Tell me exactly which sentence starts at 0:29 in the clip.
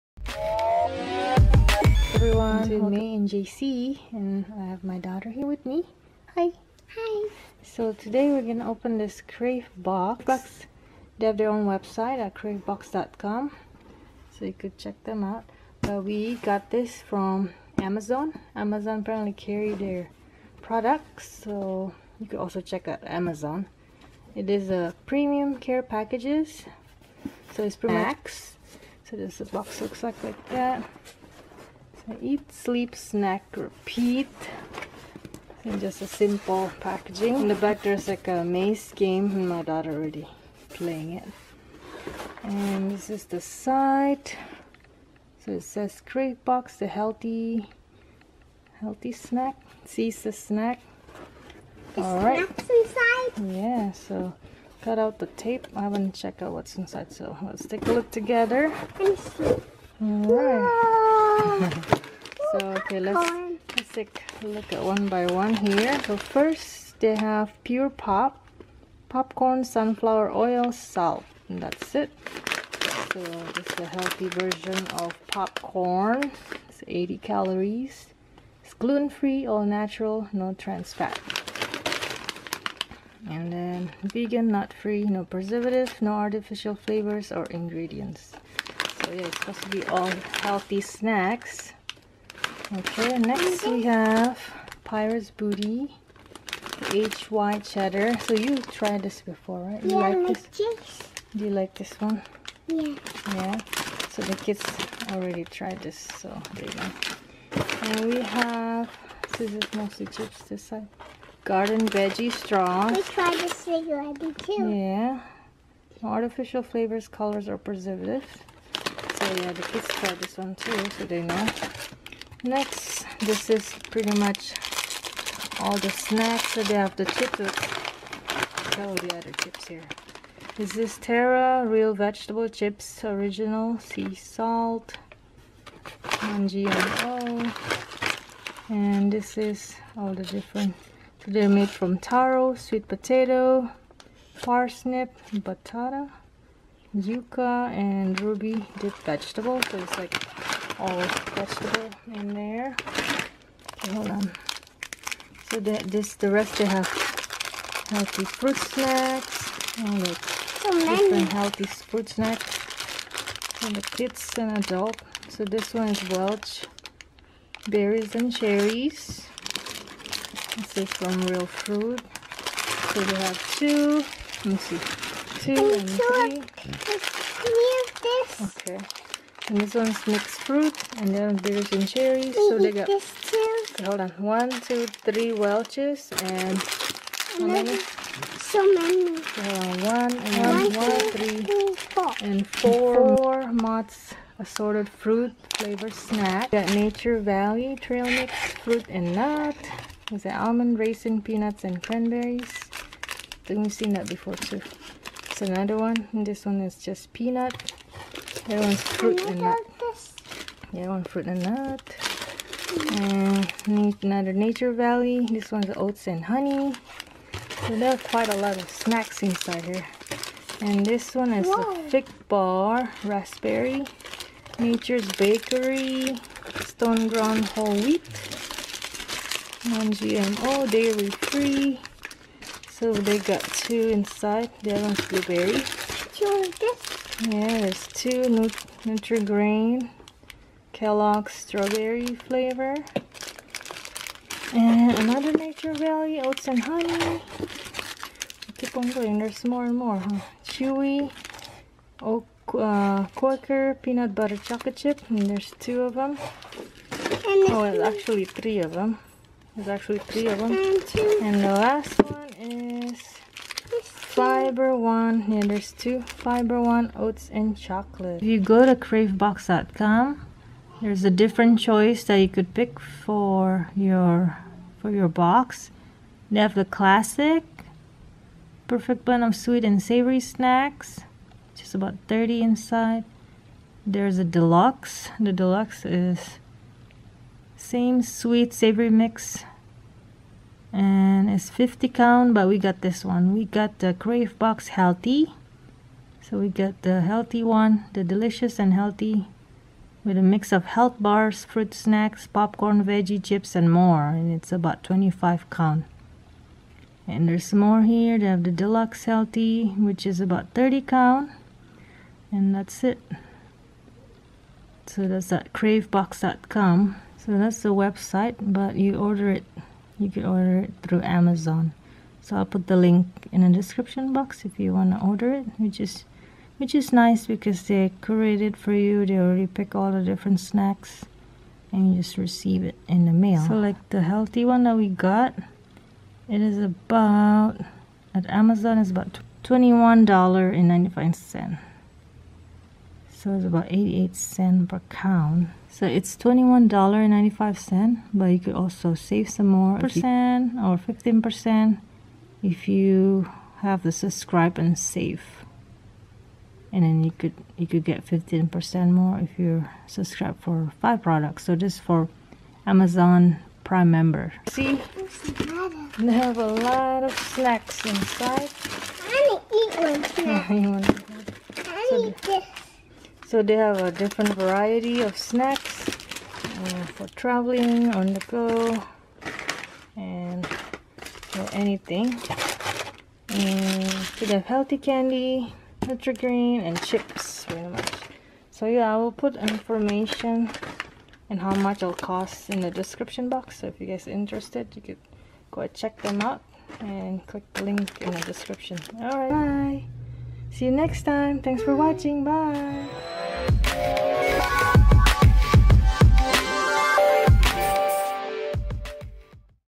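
So this box looks like like that.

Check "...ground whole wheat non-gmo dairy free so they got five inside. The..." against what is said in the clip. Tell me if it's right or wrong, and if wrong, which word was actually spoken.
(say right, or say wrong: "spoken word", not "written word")
wrong: "two", not "five".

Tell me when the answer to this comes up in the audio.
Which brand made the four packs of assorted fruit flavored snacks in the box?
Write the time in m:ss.
3:13.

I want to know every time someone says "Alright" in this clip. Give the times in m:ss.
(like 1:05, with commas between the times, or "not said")
0:51, 1:00.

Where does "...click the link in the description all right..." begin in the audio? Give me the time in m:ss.
6:37.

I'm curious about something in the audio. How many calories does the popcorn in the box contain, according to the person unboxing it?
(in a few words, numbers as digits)
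80.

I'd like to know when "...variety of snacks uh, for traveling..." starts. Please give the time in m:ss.
6:14.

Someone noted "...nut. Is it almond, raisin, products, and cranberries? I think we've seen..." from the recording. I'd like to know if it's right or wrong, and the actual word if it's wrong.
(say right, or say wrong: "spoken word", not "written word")
wrong: "peanuts", not "products".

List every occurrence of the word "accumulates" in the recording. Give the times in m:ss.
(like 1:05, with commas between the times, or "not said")
not said.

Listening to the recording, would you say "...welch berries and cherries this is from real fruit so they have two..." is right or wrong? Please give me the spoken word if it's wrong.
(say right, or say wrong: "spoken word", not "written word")
right.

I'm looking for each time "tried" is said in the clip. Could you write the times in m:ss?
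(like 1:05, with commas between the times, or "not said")
1:38, 1:45, 1:53.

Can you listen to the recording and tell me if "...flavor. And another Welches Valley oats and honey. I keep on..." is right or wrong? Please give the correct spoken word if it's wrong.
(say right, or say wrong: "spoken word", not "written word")
wrong: "Nature", not "Welches".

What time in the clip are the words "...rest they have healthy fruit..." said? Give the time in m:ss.
2:36.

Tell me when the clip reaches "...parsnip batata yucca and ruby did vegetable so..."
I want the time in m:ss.
2:24.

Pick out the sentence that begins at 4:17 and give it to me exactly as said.
Oh, well, actually three of them.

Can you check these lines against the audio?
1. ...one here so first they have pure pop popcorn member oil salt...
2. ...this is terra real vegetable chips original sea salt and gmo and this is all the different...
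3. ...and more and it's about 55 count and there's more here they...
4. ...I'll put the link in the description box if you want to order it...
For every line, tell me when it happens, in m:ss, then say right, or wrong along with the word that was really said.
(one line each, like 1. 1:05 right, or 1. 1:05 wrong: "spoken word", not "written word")
1. 1:05 wrong: "sunflower", not "member"
2. 2:10 right
3. 5:03 wrong: "25", not "55"
4. 5:22 right.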